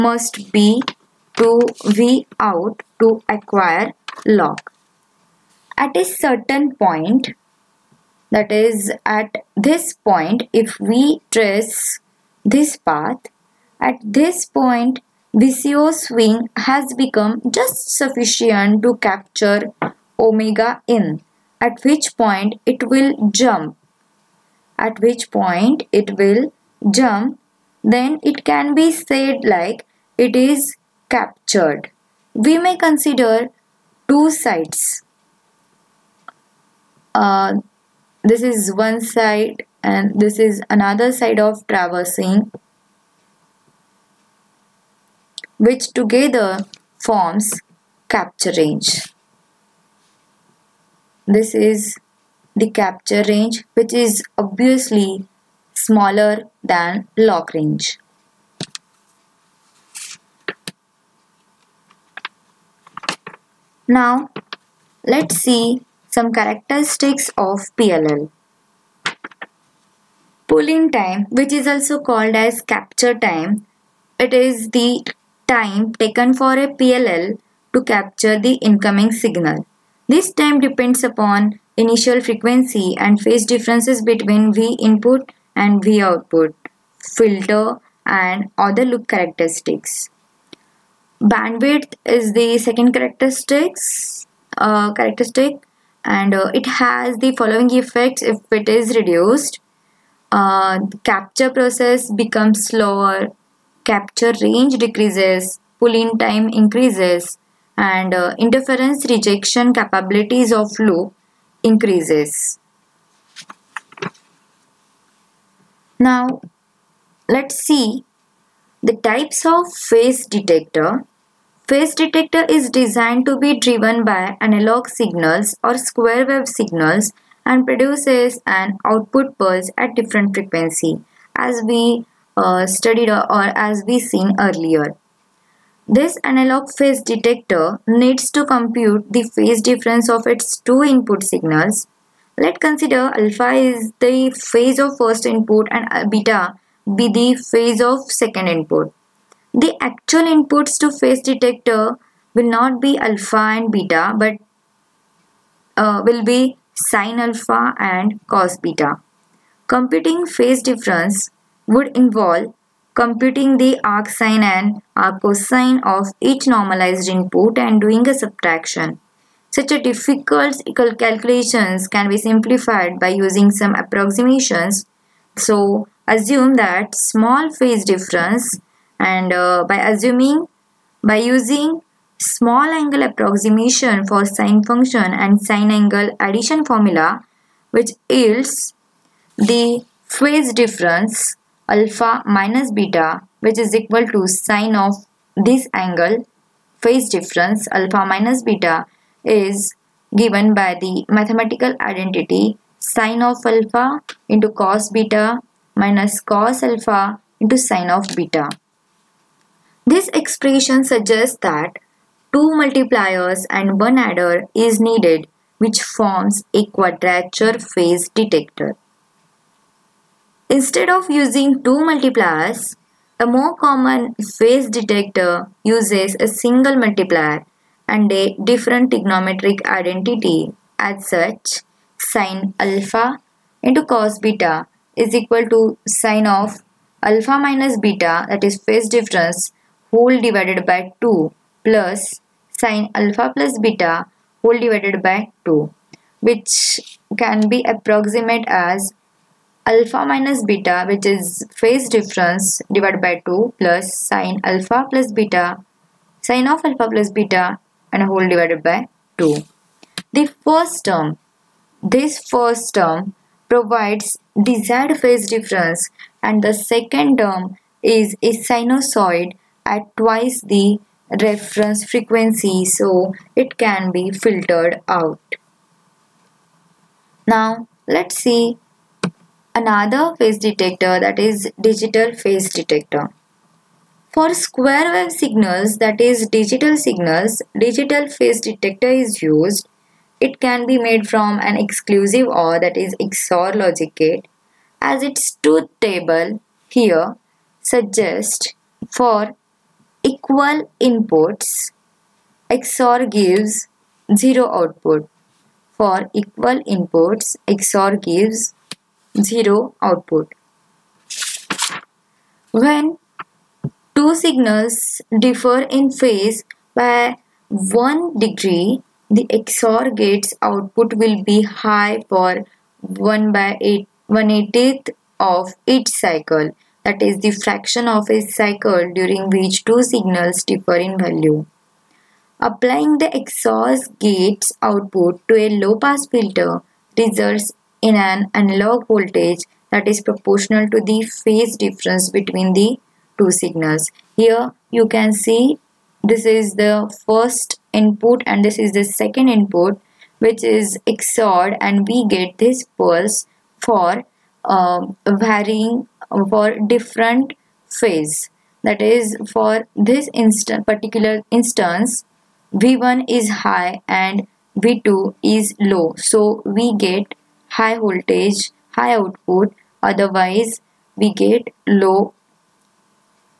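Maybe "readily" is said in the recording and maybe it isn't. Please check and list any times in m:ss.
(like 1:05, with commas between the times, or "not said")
not said.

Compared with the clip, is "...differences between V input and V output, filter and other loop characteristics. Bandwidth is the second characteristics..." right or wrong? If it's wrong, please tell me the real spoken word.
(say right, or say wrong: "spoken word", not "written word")
right.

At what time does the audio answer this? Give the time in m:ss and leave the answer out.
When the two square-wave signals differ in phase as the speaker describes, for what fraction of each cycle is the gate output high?
5:22.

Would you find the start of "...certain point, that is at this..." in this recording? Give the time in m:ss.
0:06.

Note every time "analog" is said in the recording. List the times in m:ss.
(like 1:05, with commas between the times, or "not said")
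2:04, 2:16, 5:38.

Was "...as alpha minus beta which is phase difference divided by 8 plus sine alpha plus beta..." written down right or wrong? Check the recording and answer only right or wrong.
wrong.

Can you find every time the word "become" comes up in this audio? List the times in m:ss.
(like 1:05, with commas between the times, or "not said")
0:17, 1:42.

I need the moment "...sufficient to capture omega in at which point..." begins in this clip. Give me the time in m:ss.
0:17.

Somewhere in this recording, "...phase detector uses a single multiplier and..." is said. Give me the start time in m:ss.
3:44.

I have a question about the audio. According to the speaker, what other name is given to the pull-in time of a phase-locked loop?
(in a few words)
Capture time.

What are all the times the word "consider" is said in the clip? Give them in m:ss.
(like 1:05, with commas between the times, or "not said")
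0:32, 2:22.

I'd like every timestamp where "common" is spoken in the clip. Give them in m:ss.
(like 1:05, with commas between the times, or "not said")
3:43.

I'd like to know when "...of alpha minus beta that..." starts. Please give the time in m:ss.
3:56.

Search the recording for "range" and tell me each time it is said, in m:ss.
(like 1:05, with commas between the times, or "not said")
0:48, 0:53, 0:57, 1:44.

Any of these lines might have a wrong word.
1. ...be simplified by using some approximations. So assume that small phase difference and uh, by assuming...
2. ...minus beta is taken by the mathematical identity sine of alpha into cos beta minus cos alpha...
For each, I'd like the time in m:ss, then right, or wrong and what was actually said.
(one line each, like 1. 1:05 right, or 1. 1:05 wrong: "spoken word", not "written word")
1. 2:52 right
2. 3:18 wrong: "given", not "taken".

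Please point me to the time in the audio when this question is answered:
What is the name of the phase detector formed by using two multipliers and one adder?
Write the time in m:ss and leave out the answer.
3:36.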